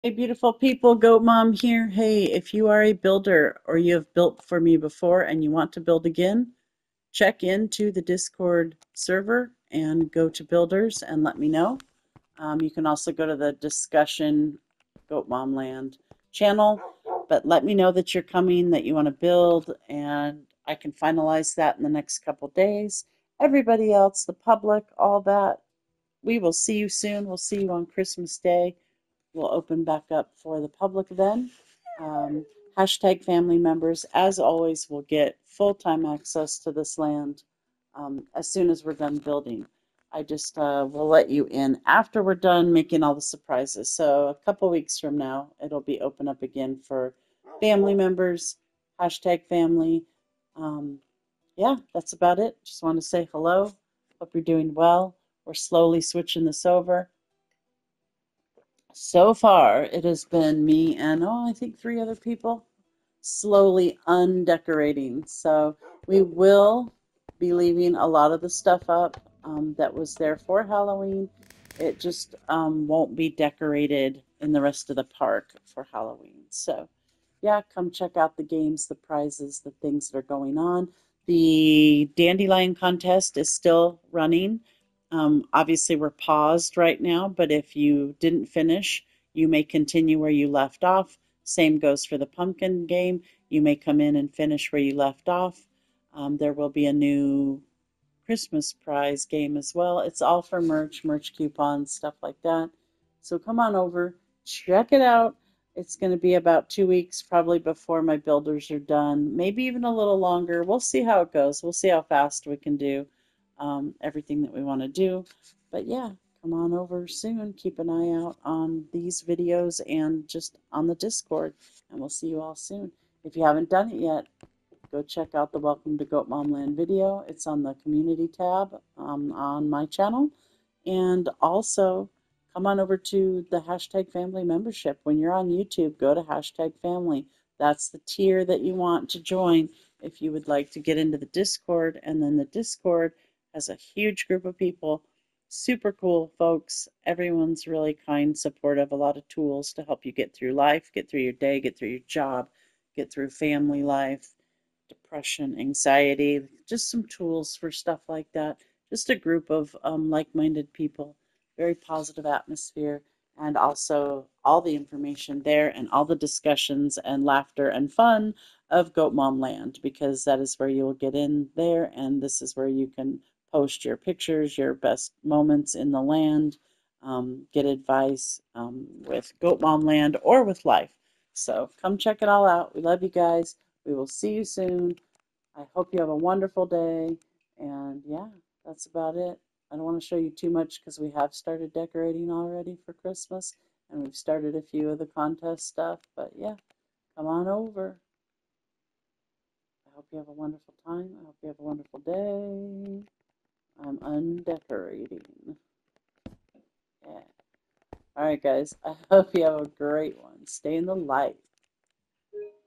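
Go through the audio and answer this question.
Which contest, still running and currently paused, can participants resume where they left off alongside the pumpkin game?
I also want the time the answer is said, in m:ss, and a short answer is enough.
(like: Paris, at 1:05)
Dandelion contest, at 1:22.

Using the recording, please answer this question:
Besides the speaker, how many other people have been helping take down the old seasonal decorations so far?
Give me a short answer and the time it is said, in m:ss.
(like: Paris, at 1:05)
3, at 1:01.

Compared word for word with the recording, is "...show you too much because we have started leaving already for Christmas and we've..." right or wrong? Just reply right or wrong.
wrong.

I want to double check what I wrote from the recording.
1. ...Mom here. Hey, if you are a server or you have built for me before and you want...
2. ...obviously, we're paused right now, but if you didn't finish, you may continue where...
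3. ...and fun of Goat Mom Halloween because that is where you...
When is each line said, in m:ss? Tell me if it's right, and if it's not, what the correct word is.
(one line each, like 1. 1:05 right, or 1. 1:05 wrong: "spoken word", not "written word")
1. 0:01 wrong: "builder", not "server"
2. 1:25 right
3. 2:47 wrong: "Land", not "Halloween".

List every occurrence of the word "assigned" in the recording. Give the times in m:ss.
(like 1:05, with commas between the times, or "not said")
not said.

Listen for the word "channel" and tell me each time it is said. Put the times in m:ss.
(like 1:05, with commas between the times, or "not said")
0:16, 2:09.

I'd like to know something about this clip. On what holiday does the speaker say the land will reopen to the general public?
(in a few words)
Christmas Day.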